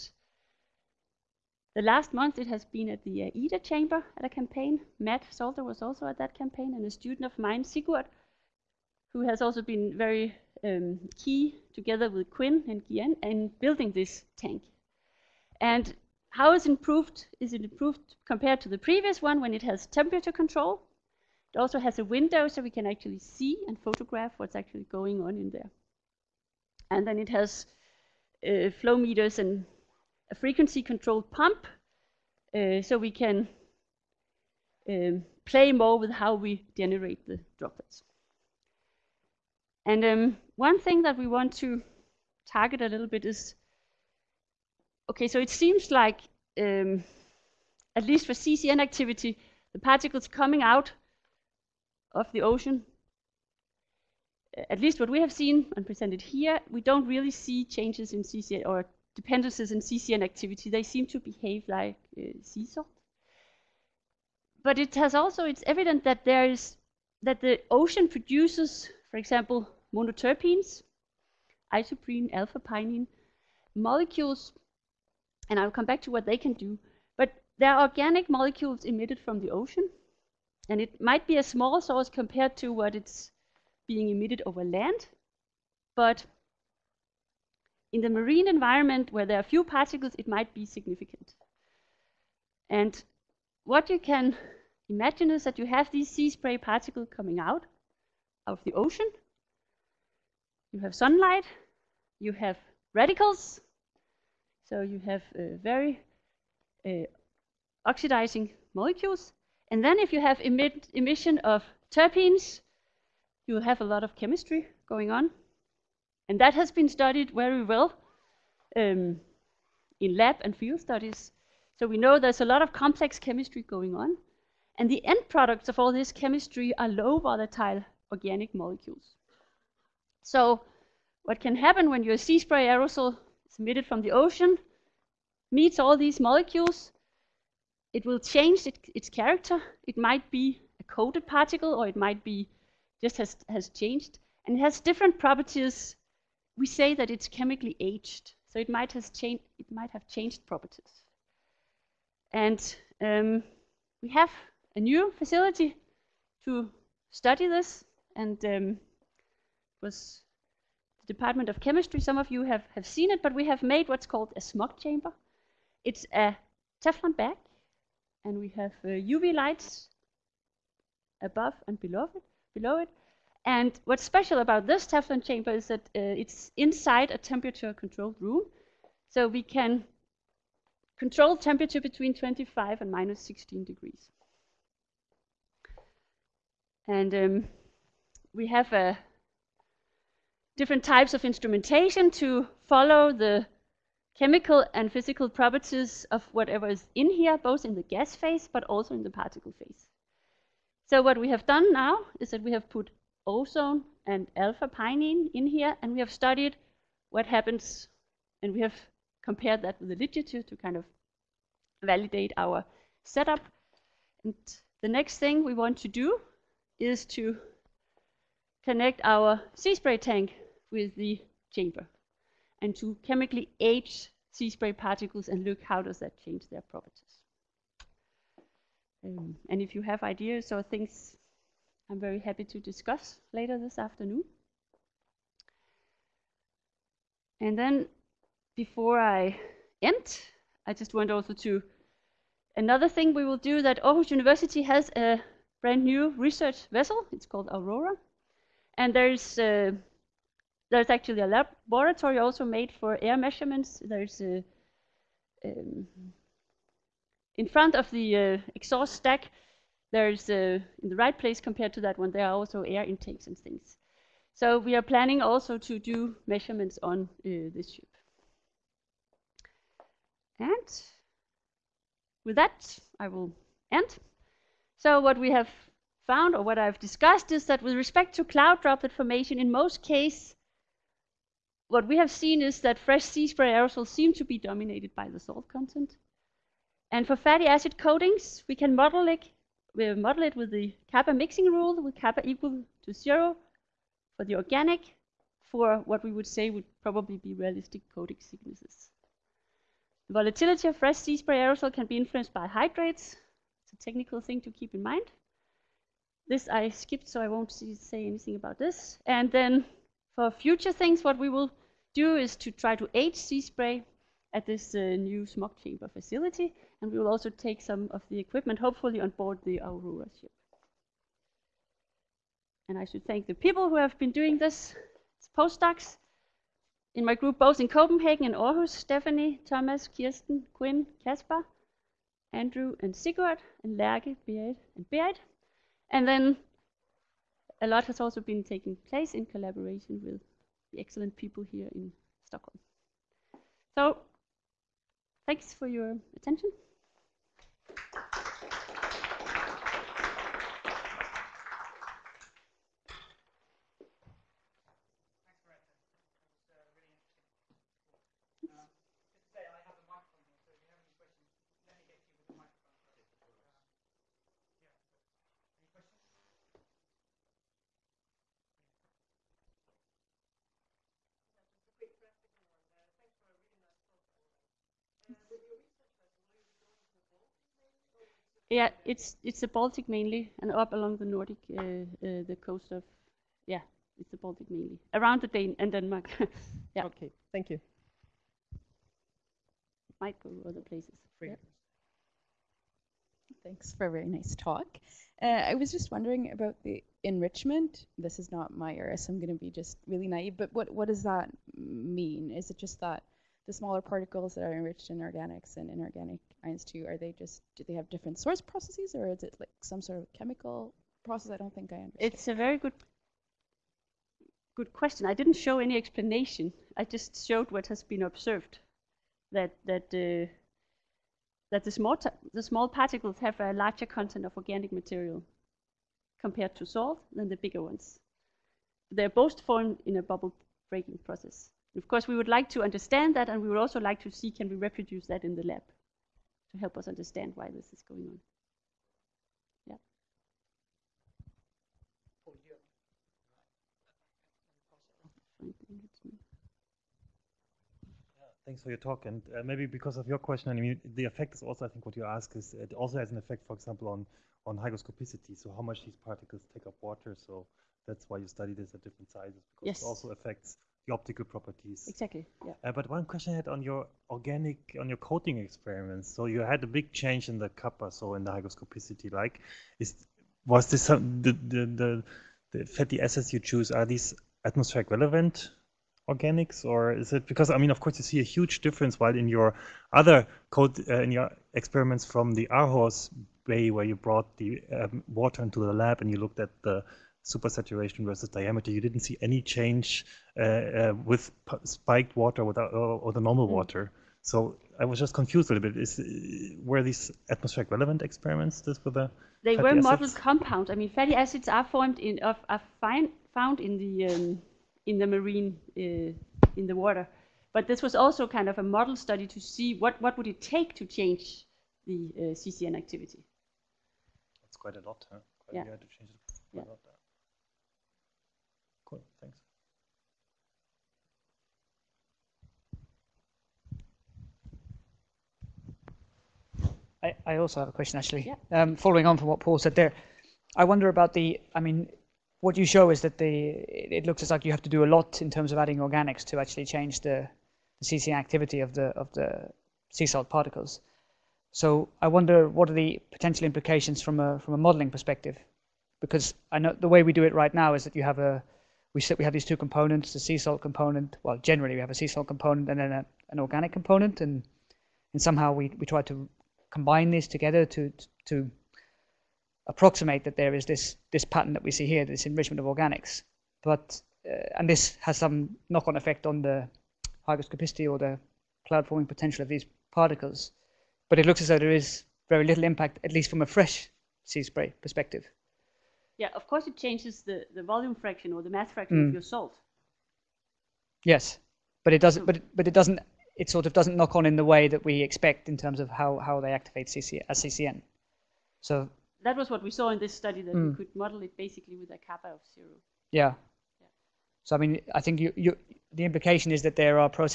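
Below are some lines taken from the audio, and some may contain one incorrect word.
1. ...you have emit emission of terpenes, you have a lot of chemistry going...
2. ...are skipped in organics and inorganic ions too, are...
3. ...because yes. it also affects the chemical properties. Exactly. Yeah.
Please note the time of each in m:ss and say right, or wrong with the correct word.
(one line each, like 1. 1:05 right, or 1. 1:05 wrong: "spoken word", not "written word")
1. 1:50 right
2. 6:44 wrong: "enriched", not "skipped"
3. 7:39 wrong: "optical", not "chemical".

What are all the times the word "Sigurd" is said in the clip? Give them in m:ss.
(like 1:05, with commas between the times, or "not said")
0:07, 5:32.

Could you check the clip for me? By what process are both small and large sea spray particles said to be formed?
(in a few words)
Bubble breaking.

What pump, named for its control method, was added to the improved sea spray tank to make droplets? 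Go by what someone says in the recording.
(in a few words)
Frequency controlled pump.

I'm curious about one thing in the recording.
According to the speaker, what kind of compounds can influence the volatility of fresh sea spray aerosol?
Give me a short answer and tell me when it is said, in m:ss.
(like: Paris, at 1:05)
Hydrates, at 5:02.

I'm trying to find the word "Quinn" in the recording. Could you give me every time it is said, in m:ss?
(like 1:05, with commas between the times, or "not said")
0:12, 5:30.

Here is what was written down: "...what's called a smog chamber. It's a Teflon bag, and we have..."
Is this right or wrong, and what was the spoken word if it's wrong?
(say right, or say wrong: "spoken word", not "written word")
right.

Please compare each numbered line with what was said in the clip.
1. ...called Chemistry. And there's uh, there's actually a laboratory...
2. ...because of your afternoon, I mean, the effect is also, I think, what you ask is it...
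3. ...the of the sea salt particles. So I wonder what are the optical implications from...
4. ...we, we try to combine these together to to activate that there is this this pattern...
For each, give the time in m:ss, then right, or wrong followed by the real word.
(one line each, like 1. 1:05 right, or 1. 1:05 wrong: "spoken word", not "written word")
1. 4:07 wrong: "Aurora", not "Chemistry"
2. 7:29 wrong: "question", not "afternoon"
3. 8:58 wrong: "potential", not "optical"
4. 9:15 wrong: "approximate", not "activate".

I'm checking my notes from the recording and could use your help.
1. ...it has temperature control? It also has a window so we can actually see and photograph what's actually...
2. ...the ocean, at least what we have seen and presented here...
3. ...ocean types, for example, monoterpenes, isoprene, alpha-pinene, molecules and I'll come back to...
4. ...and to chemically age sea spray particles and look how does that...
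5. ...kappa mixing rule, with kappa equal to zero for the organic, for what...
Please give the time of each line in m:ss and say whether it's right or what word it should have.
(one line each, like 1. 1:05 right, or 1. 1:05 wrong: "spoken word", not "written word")
1. 0:19 right
2. 0:52 right
3. 1:07 wrong: "produces", not "types"
4. 3:42 right
5. 4:50 right.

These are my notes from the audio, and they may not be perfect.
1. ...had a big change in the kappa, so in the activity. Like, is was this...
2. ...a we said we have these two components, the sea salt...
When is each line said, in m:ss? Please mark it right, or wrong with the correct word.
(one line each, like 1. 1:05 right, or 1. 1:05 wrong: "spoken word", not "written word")
1. 7:46 wrong: "hygroscopicity", not "activity"
2. 9:08 right.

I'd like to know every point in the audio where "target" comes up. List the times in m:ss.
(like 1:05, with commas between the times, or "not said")
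0:42.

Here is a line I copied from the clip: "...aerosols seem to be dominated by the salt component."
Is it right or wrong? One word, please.
wrong.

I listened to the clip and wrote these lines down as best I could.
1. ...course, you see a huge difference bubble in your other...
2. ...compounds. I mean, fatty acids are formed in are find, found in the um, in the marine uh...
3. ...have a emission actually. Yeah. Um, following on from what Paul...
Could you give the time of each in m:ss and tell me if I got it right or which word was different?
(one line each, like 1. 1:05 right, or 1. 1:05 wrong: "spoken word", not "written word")
1. 7:57 wrong: "while", not "bubble"
2. 8:20 right
3. 8:47 wrong: "question", not "emission".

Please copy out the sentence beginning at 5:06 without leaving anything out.
This I skipped, so I won't see, say anything about this.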